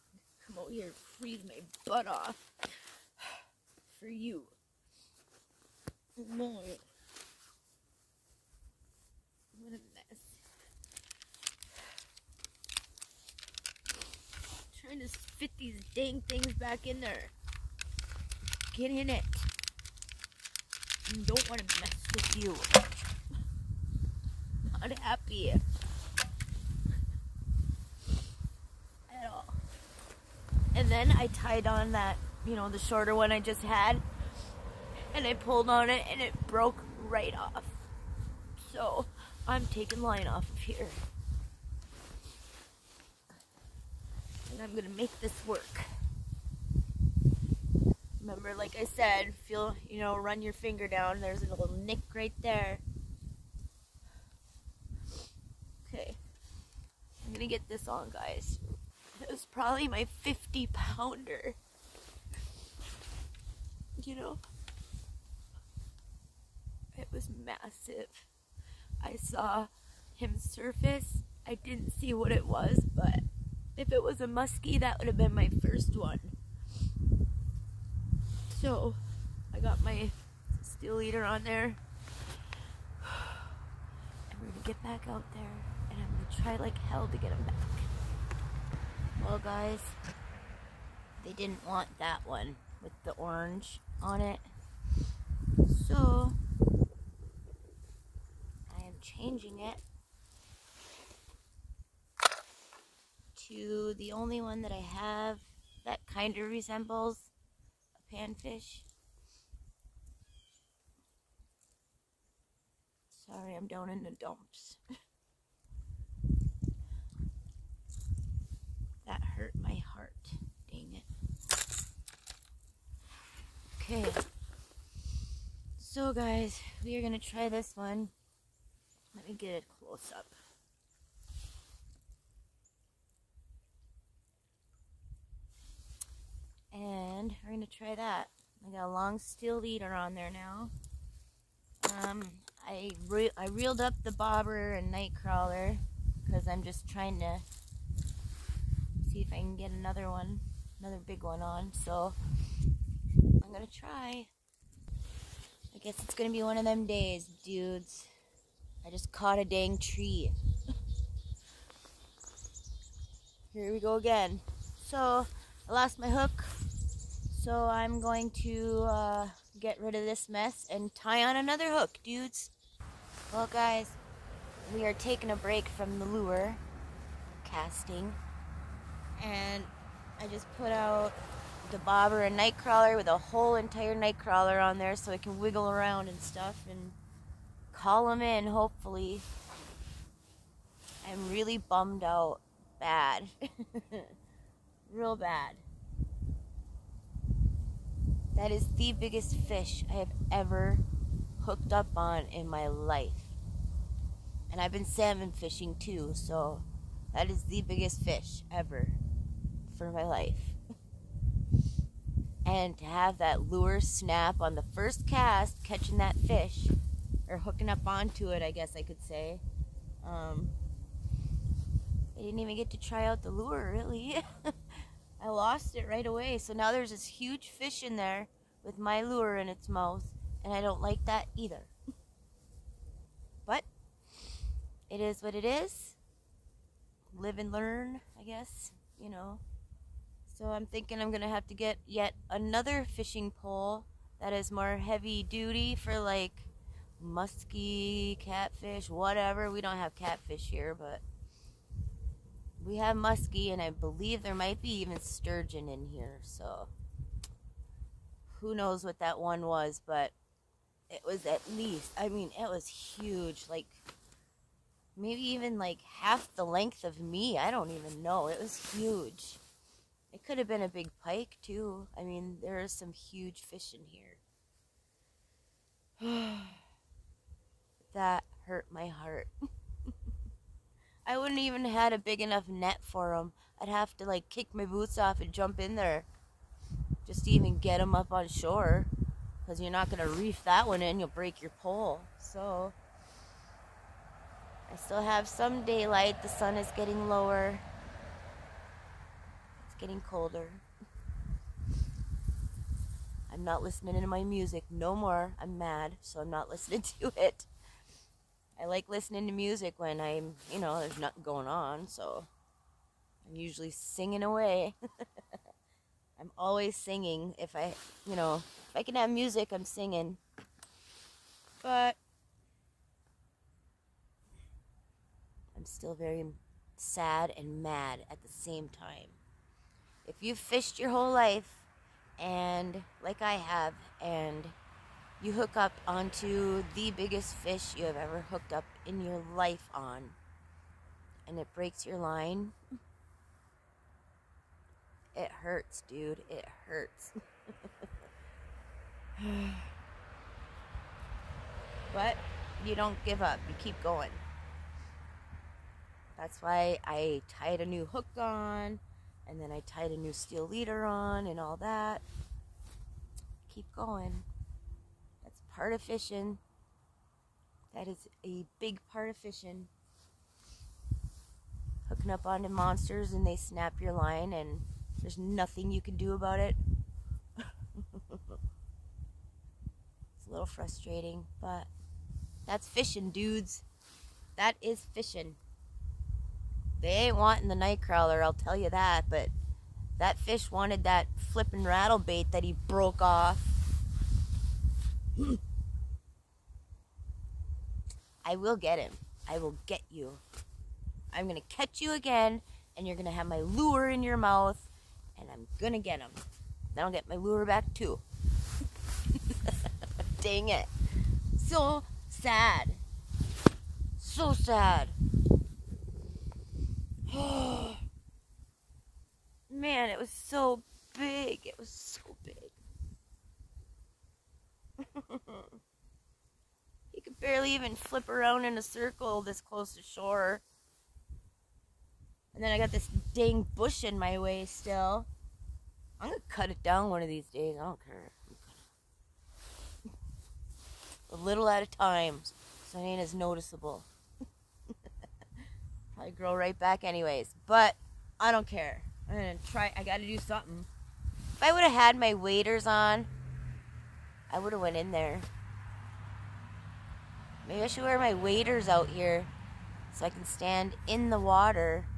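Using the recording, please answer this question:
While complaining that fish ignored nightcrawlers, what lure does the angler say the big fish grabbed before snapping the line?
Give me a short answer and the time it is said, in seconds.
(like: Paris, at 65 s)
rattle bait, at 391 s.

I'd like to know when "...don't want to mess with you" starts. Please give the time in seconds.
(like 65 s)
21 s.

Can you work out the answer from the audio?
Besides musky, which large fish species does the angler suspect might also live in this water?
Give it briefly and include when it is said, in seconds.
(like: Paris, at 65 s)
sturgeon, at 254 s.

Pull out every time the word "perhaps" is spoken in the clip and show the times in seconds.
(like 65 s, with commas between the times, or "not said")
not said.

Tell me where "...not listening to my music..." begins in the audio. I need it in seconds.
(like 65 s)
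303 s.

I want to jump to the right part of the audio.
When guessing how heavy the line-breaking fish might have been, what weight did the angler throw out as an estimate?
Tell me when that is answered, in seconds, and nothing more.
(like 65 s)
60 s.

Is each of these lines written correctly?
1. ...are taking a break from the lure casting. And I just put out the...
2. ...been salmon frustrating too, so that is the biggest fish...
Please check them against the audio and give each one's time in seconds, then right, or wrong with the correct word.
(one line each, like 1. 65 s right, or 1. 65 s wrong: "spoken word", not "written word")
1. 174 s right
2. 204 s wrong: "fishing", not "frustrating".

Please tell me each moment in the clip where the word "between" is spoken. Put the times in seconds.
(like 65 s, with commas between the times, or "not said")
not said.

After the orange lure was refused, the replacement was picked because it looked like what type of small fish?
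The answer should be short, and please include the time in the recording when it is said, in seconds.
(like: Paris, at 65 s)
panfish, at 108 s.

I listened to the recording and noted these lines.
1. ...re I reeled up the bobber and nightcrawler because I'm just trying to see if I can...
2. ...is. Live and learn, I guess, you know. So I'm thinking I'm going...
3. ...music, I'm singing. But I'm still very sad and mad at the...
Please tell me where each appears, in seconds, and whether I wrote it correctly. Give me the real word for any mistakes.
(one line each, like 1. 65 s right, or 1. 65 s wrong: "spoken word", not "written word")
1. 143 s right
2. 235 s right
3. 319 s right.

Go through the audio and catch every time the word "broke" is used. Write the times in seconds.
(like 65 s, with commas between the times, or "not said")
36 s, 392 s.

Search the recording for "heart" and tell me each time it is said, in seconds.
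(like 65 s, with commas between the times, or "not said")
119 s, 278 s.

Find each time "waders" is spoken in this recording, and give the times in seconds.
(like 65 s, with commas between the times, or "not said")
452 s, 458 s.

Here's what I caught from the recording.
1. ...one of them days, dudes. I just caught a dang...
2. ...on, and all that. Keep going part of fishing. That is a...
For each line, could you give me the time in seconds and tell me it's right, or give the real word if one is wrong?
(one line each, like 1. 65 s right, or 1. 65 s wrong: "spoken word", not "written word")
1. 156 s right
2. 360 s right.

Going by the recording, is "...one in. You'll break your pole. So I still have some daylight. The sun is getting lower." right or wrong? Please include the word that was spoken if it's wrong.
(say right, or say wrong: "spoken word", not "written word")
right.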